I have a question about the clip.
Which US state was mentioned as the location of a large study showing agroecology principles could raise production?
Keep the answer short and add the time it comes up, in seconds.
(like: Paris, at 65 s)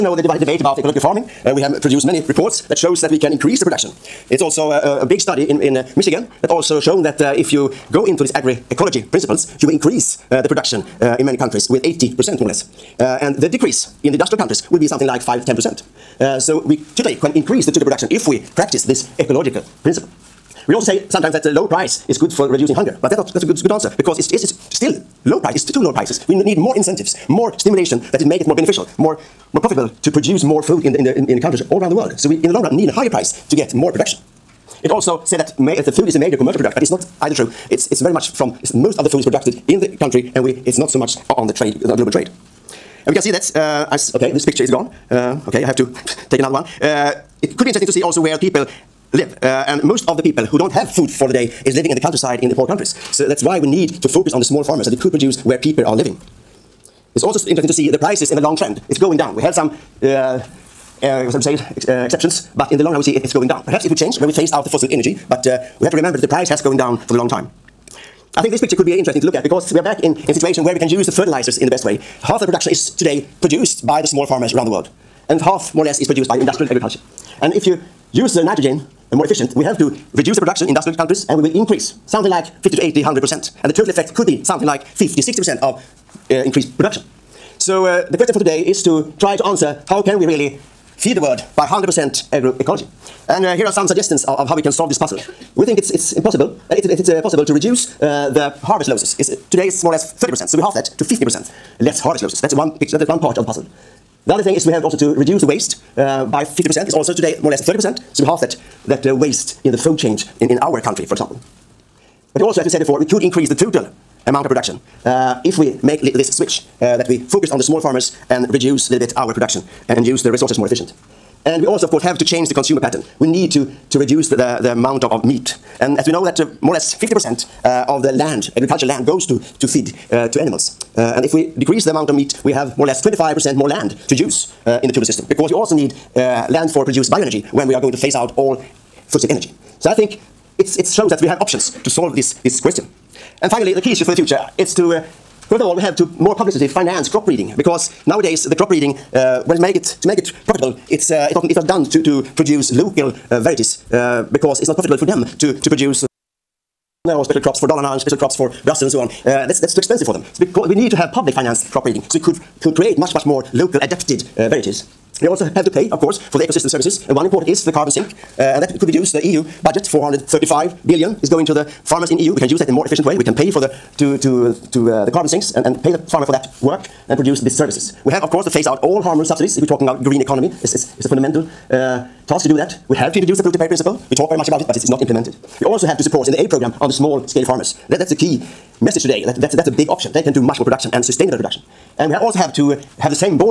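Michigan, at 5 s.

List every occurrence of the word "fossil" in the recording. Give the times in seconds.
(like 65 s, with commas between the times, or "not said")
64 s, 139 s.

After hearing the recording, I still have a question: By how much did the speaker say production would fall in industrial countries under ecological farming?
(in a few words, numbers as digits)
5-10%.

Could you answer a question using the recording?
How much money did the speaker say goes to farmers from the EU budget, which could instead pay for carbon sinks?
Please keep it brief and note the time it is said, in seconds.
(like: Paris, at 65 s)
435 billion, at 169 s.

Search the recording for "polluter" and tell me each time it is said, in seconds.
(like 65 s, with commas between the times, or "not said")
183 s.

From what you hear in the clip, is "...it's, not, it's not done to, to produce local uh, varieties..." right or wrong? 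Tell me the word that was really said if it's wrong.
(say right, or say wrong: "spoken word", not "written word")
right.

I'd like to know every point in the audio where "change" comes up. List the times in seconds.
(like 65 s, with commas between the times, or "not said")
63 s, 122 s.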